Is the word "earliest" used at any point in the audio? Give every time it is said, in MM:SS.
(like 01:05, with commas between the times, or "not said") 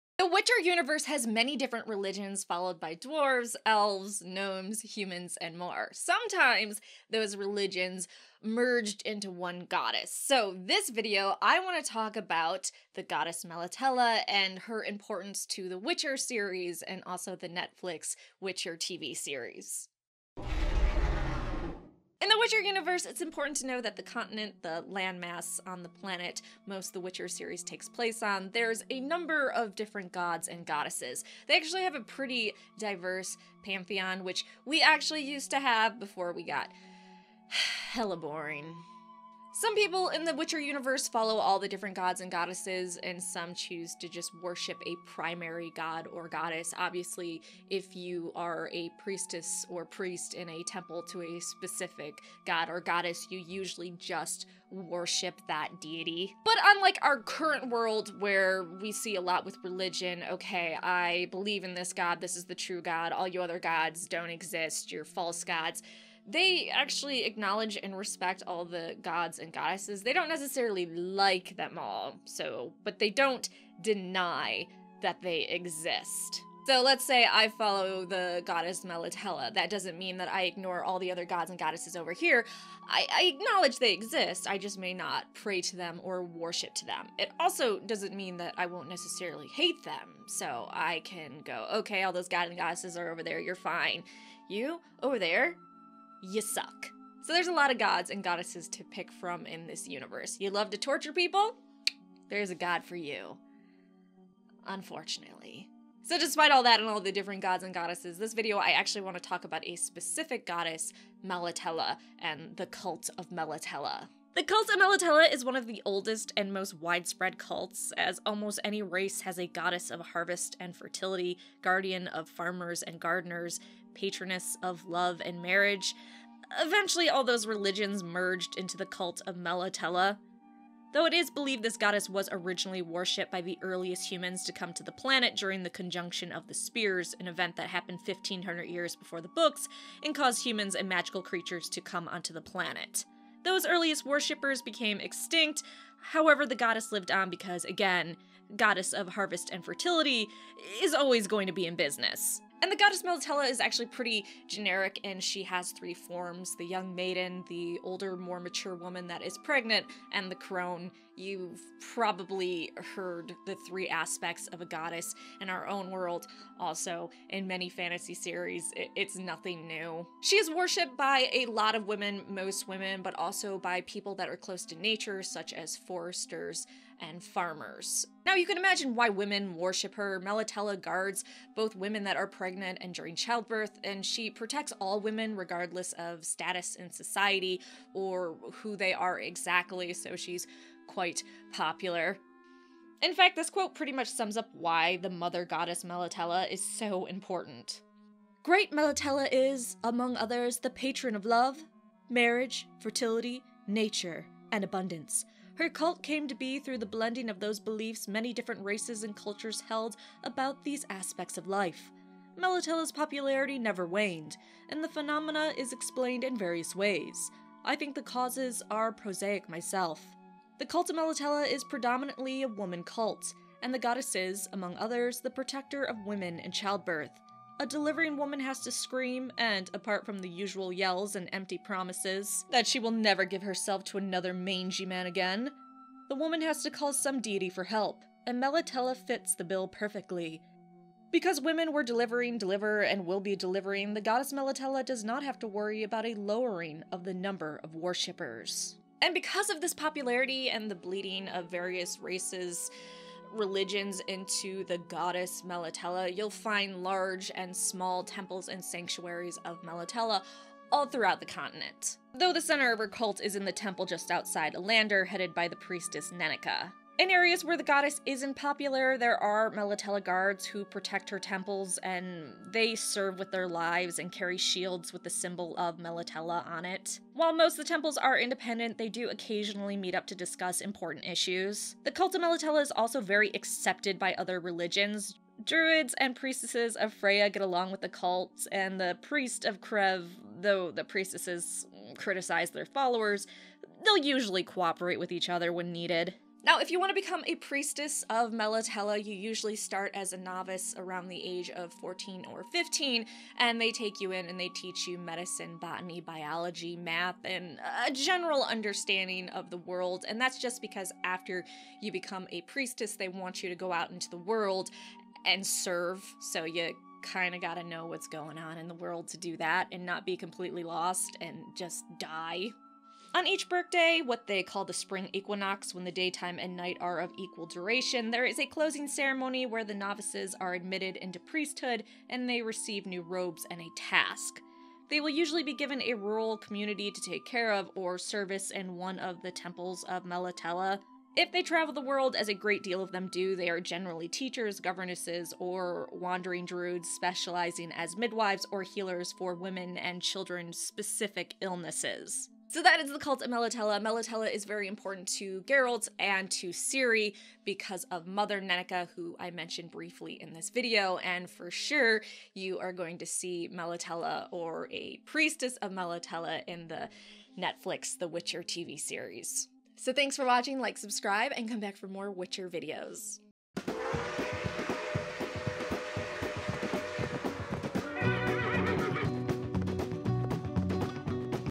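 02:13, 02:23.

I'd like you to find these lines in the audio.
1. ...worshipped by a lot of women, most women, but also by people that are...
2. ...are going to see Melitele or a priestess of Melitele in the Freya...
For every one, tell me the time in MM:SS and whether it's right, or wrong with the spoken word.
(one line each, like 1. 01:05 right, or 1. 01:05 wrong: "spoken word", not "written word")
1. 02:50 right
2. 06:02 wrong: "Netflix", not "Freya".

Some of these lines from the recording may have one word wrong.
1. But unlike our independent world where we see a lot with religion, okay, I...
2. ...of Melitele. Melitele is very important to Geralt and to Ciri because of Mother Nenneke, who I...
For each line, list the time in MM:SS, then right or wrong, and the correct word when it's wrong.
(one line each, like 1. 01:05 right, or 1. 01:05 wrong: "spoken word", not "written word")
1. 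00:56 wrong: "current", not "independent"
2. 05:53 right.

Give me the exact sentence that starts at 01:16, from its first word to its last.
So let's say I follow the goddess Melitele.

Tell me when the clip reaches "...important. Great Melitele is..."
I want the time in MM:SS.
03:17.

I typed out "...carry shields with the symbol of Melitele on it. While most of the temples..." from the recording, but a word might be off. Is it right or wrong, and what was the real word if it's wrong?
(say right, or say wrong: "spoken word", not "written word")
right.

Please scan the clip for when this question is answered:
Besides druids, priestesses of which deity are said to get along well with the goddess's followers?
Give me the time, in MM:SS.
04:46.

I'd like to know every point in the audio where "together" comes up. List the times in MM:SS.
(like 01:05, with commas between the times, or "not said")
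not said.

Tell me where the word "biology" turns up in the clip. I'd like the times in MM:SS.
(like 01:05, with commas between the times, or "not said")
05:06.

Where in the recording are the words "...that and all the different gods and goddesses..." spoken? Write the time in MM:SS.
01:46.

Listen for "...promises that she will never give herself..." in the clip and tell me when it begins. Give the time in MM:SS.
03:51.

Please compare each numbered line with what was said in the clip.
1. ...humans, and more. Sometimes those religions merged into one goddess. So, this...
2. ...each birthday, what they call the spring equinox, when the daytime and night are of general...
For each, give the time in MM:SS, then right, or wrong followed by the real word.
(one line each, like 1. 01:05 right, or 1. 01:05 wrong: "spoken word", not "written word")
1. 00:04 right
2. 05:23 wrong: "equal", not "general".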